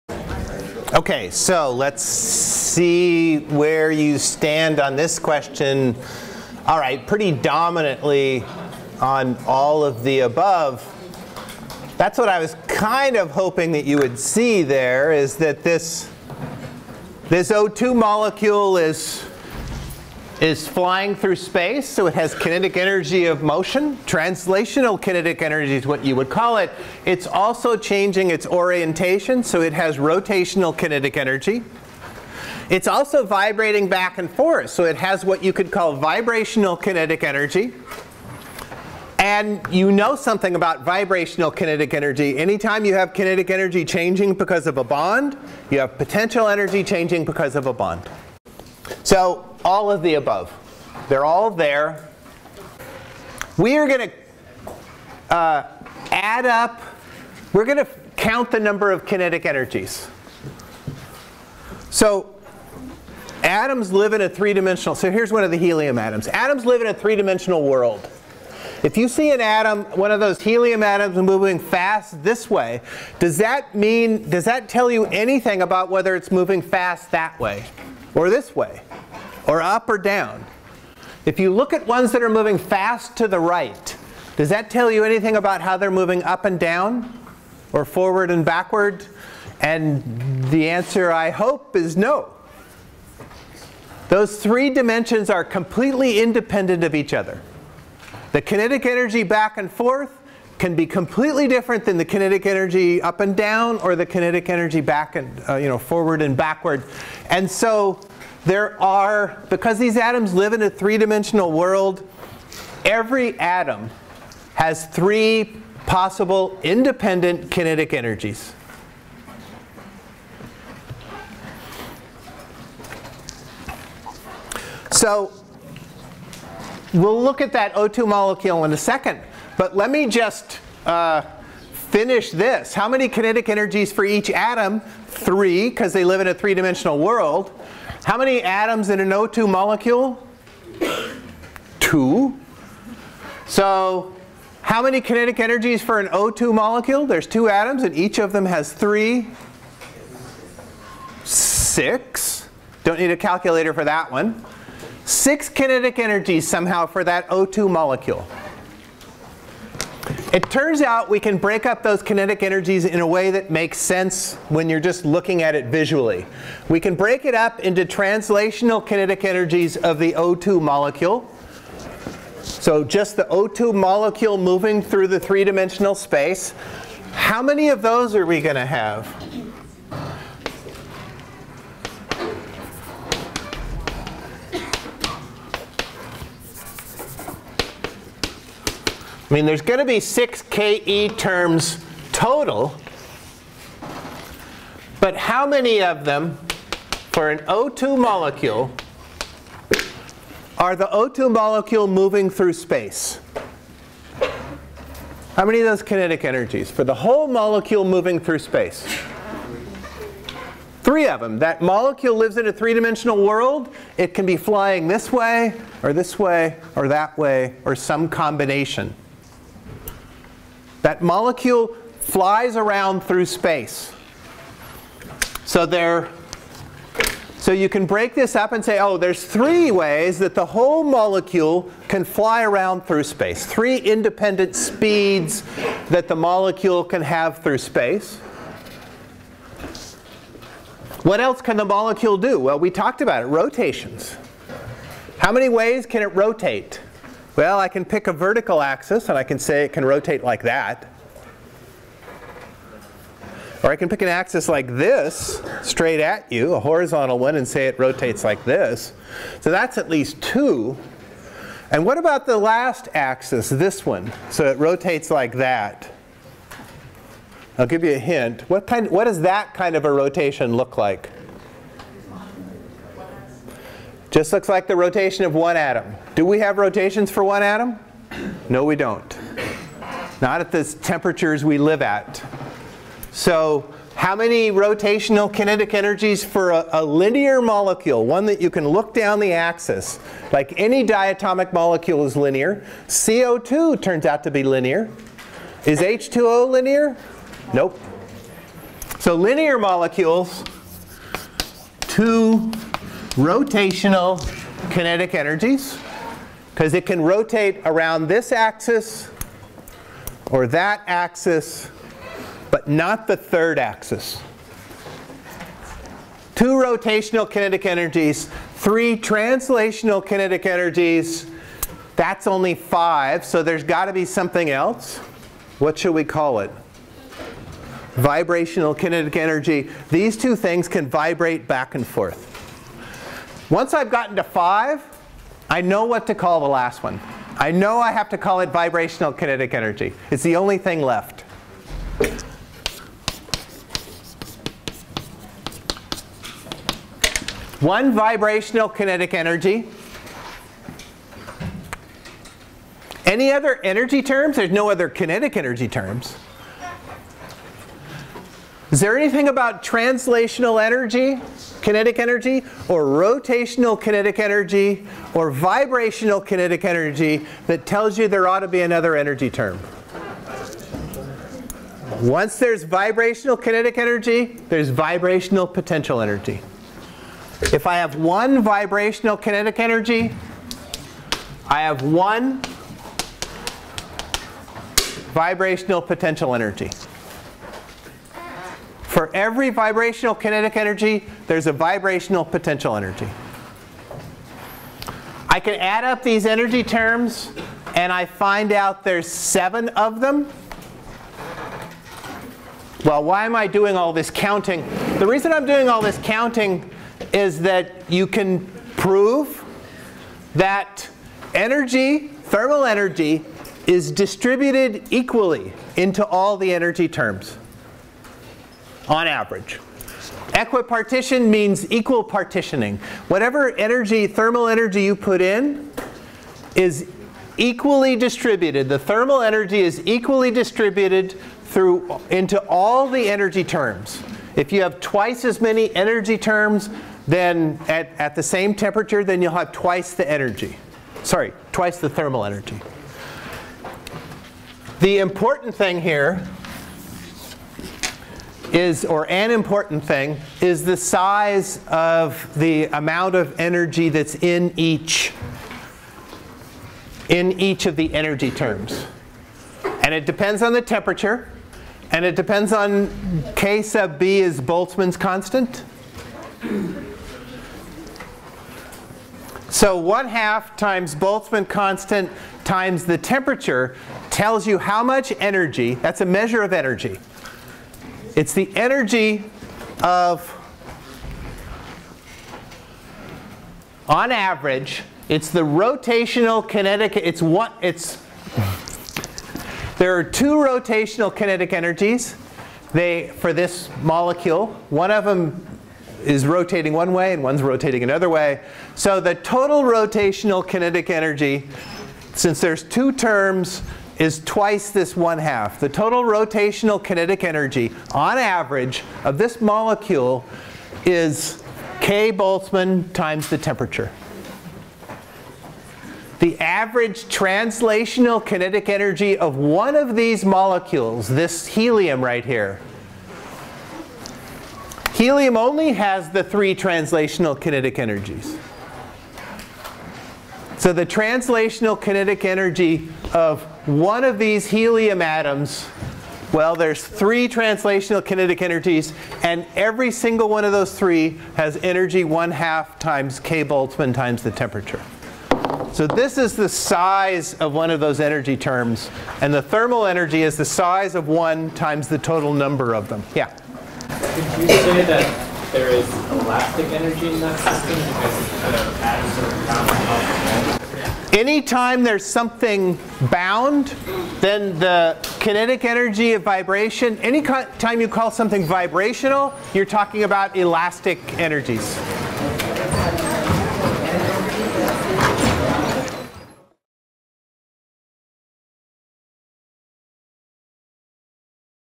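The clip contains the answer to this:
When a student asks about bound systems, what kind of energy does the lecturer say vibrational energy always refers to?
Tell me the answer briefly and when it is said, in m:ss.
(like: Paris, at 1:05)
Elastic energies, at 9:30.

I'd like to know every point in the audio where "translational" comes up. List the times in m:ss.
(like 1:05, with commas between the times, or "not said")
0:24, 2:47, 5:18, 5:59, 8:37, 8:46, 8:50, 8:57.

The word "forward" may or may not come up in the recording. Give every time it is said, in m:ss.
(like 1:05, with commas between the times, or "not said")
1:27, 1:45.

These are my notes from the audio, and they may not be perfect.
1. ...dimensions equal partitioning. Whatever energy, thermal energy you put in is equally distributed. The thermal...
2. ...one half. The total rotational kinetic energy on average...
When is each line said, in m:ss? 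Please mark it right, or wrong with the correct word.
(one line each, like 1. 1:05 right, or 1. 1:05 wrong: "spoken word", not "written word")
1. 7:01 wrong: "means", not "dimensions"
2. 8:24 right.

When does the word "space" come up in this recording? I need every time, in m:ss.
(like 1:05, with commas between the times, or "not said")
0:21, 2:55, 3:22, 3:28, 3:43, 3:53, 3:57.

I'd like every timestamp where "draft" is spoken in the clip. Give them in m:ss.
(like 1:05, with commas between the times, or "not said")
not said.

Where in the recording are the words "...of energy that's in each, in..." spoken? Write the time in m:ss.
7:33.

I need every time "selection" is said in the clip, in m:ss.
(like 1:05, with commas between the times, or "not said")
not said.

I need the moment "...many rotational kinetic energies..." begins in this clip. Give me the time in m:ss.
4:44.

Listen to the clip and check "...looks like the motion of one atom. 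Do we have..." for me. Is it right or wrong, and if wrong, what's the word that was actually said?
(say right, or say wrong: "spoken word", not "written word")
wrong: "rotation", not "motion".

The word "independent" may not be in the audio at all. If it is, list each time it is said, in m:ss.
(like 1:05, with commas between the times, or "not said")
1:36, 1:56, 3:53.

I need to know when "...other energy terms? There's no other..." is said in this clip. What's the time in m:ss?
5:53.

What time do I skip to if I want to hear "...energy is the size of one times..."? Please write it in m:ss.
9:09.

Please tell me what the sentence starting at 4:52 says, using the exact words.
CO2 turns out to be linear.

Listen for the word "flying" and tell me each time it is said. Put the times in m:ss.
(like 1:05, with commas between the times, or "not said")
0:20, 3:34.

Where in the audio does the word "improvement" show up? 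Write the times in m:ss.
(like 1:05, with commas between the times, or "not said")
not said.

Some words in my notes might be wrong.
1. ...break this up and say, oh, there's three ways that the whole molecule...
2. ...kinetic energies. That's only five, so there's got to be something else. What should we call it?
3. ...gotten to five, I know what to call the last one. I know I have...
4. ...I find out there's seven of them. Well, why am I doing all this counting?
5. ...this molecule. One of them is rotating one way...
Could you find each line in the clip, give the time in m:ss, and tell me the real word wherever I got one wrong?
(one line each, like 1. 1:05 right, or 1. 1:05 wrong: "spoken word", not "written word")
1. 3:47 right
2. 5:20 right
3. 5:33 right
4. 6:37 right
5. 8:13 right.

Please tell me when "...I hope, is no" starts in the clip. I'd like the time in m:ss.
1:31.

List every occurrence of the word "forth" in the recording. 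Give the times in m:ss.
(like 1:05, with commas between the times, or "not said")
0:34, 1:39, 5:31.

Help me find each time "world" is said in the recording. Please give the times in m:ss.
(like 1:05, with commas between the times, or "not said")
1:07, 1:51, 2:16, 3:33.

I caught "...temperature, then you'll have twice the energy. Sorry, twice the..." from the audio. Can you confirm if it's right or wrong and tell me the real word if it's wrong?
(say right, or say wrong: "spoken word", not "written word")
right.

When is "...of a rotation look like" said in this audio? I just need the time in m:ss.
4:29.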